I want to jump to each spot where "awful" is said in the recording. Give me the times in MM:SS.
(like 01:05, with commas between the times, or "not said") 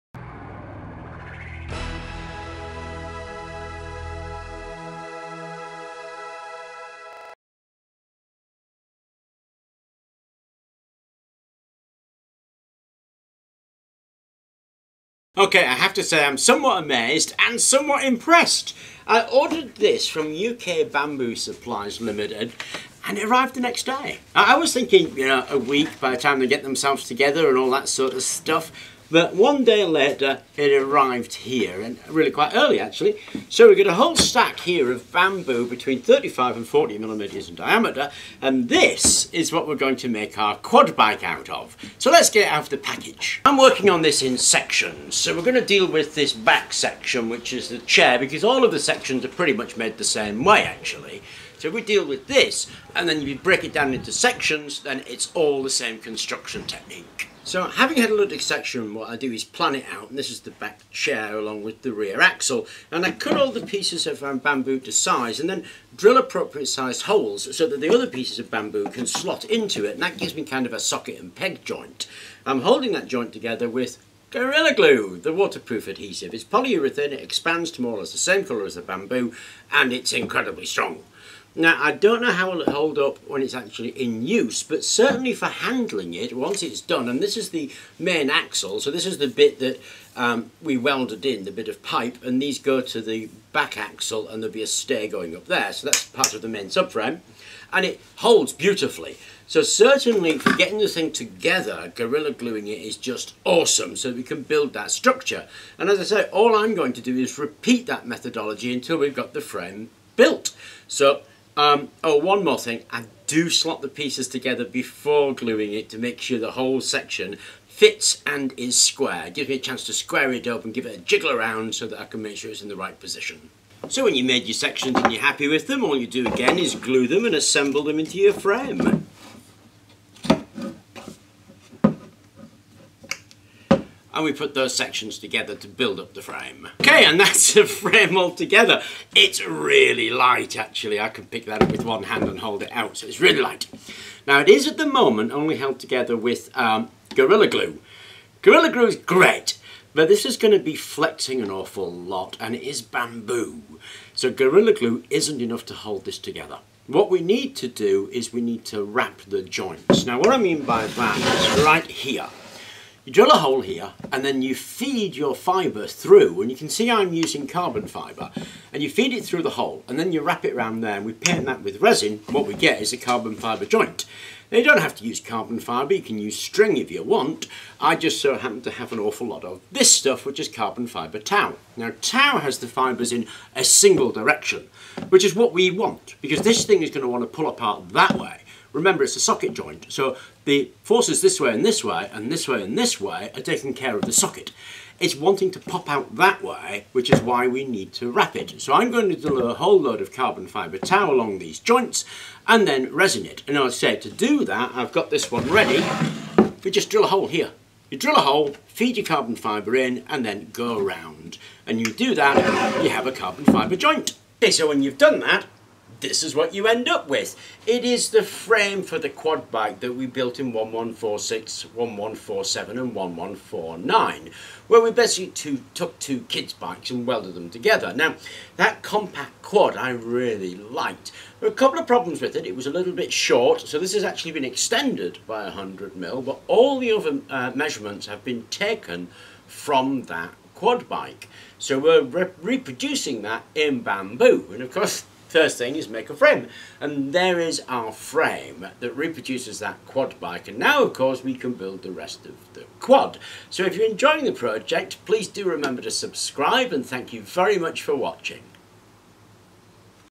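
02:31, 02:58.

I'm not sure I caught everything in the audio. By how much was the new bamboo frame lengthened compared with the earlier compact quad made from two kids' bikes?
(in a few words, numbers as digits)
100 mm.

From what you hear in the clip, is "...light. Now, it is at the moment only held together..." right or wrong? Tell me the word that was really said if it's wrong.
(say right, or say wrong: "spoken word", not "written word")
right.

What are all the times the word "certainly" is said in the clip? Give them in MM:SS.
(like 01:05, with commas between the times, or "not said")
01:24, 01:39.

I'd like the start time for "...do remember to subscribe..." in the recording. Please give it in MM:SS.
04:15.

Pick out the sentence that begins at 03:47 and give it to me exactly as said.
Now, that compact quad I really liked.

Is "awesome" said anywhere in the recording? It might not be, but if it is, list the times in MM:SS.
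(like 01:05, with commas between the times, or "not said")
01:43.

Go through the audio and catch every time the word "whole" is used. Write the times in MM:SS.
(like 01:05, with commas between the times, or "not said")
00:33, 01:56, 03:19.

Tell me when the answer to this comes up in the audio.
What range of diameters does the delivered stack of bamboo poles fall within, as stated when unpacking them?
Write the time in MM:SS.
00:35.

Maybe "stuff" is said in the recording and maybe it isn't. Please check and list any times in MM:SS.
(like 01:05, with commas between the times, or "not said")
00:28, 02:59.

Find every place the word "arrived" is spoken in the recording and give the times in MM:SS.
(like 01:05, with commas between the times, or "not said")
00:23, 00:30.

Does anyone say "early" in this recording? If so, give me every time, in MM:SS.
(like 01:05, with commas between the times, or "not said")
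00:32.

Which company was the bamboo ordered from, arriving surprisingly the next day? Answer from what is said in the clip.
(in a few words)
UK Bamboo Supplies Limited.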